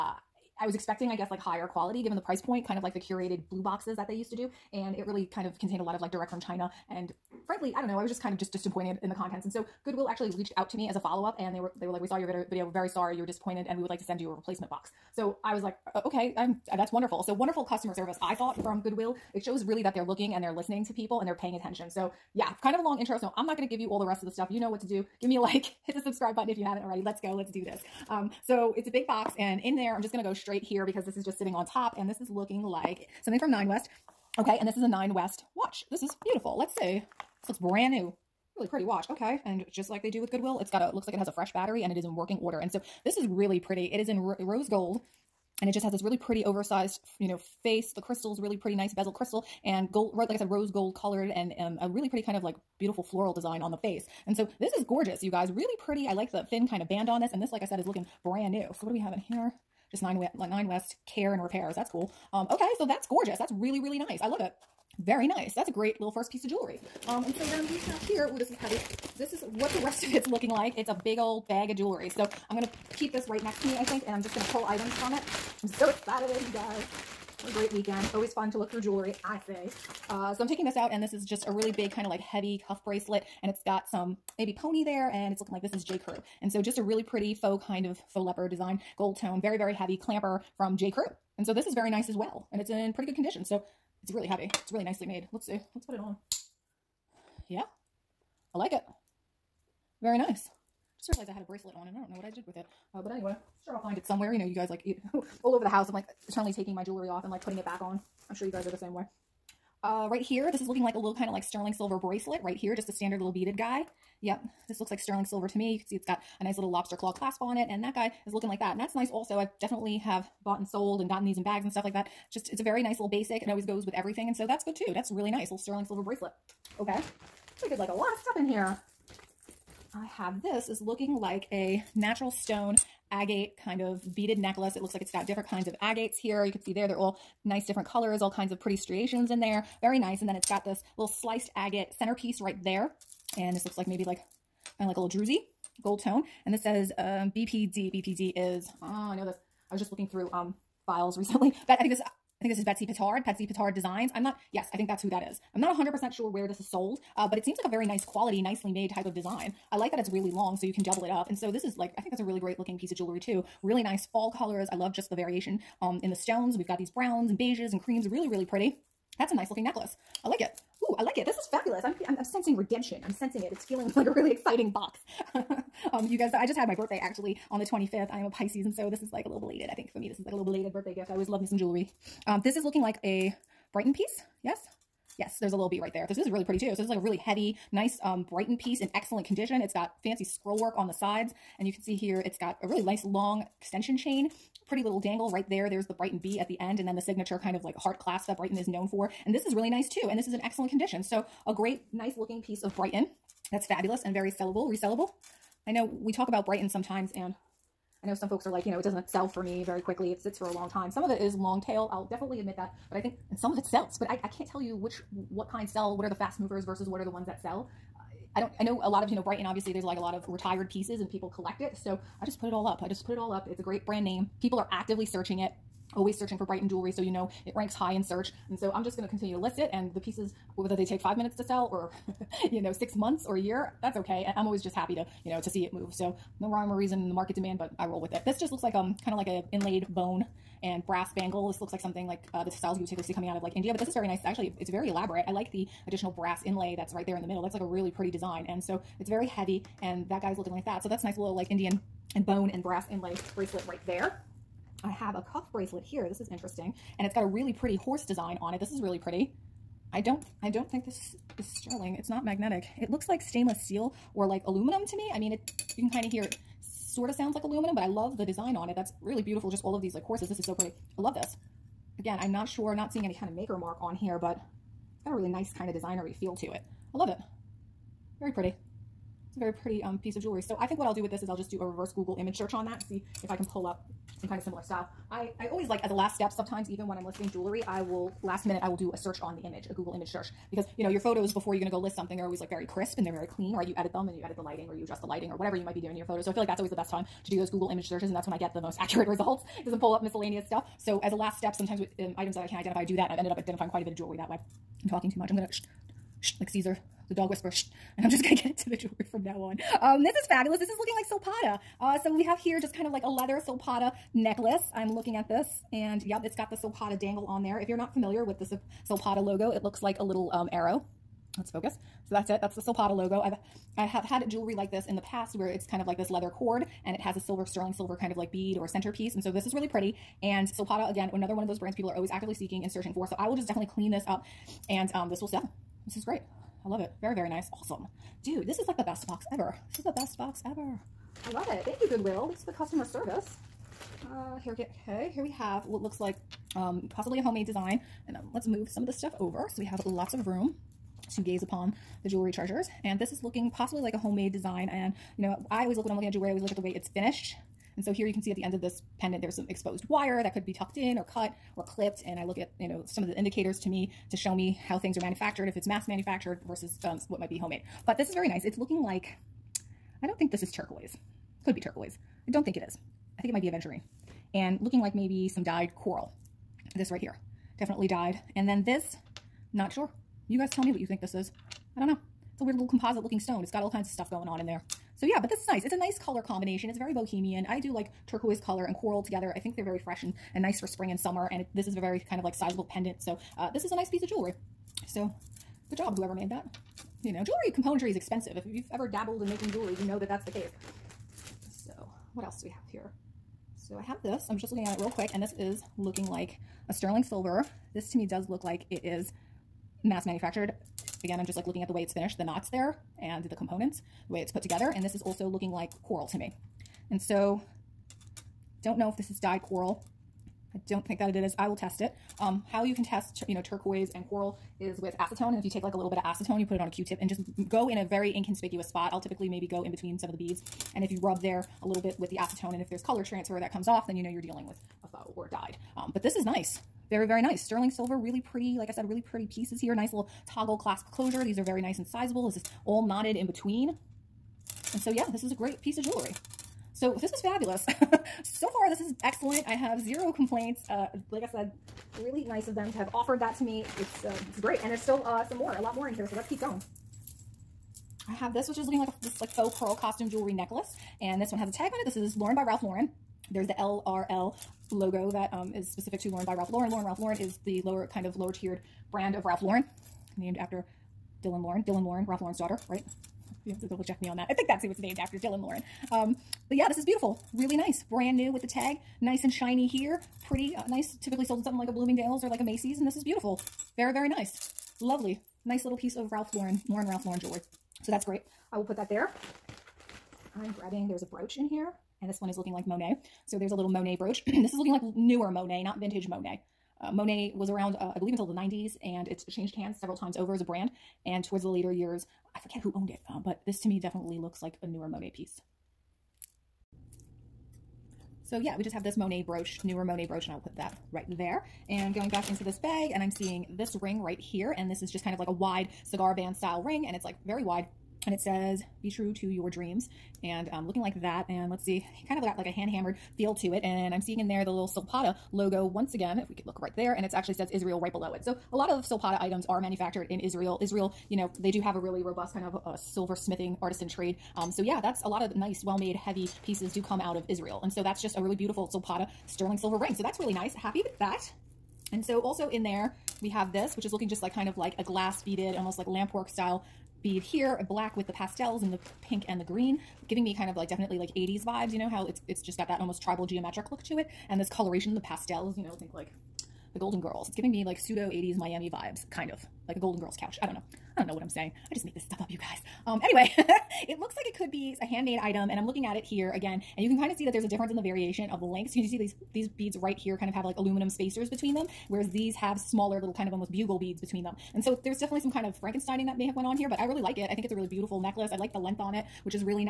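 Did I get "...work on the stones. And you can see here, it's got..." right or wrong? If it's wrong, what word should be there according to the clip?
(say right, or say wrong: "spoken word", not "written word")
wrong: "sides", not "stones".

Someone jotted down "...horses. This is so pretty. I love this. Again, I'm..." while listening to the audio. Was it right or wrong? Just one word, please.
right.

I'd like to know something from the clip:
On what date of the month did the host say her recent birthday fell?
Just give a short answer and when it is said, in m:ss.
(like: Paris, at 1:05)
25th, at 2:57.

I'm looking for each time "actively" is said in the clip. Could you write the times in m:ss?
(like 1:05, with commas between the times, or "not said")
3:44, 5:32.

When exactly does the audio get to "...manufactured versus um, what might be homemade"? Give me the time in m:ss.
6:05.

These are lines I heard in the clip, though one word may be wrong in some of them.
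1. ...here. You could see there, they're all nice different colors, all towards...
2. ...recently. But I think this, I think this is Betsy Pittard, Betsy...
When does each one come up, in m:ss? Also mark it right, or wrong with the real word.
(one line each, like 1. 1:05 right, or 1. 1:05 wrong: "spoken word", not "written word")
1. 2:16 wrong: "kinds", not "towards"
2. 2:31 right.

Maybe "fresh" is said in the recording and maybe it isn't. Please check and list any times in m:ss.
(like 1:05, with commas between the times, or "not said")
0:41, 6:29.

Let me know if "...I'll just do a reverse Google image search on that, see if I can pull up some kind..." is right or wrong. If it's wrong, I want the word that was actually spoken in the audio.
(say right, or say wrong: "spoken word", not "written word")
right.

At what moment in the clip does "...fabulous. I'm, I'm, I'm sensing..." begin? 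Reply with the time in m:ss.
2:51.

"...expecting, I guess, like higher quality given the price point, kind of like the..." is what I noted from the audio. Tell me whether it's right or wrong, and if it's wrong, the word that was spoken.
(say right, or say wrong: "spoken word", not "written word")
right.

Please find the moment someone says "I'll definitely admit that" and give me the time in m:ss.
3:31.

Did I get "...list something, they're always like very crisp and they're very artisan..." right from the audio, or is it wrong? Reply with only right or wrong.
wrong.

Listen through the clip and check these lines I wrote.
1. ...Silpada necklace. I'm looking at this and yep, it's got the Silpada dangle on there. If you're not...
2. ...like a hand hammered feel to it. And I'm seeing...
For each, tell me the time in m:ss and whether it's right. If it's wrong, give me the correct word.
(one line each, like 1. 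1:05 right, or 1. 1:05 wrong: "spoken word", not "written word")
1. 5:13 right
2. 8:42 right.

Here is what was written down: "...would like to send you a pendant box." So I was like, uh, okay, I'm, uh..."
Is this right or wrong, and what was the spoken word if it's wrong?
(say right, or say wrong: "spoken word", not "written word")
wrong: "replacement", not "pendant".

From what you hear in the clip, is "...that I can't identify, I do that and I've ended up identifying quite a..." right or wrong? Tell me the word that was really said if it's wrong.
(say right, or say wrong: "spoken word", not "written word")
right.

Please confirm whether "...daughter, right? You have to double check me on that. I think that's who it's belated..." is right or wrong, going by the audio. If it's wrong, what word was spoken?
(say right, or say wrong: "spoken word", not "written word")
wrong: "named", not "belated".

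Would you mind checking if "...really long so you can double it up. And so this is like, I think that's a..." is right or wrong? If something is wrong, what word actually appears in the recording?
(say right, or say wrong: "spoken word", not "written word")
right.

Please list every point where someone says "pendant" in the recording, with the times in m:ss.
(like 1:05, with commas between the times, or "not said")
5:58, 6:32.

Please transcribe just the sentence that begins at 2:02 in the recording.
Just, it's a very nice little basic.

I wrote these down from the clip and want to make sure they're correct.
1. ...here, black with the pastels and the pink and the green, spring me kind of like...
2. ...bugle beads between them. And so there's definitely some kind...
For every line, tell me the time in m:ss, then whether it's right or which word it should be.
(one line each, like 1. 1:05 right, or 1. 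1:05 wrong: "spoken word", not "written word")
1. 9:07 wrong: "giving", not "spring"
2. 9:33 right.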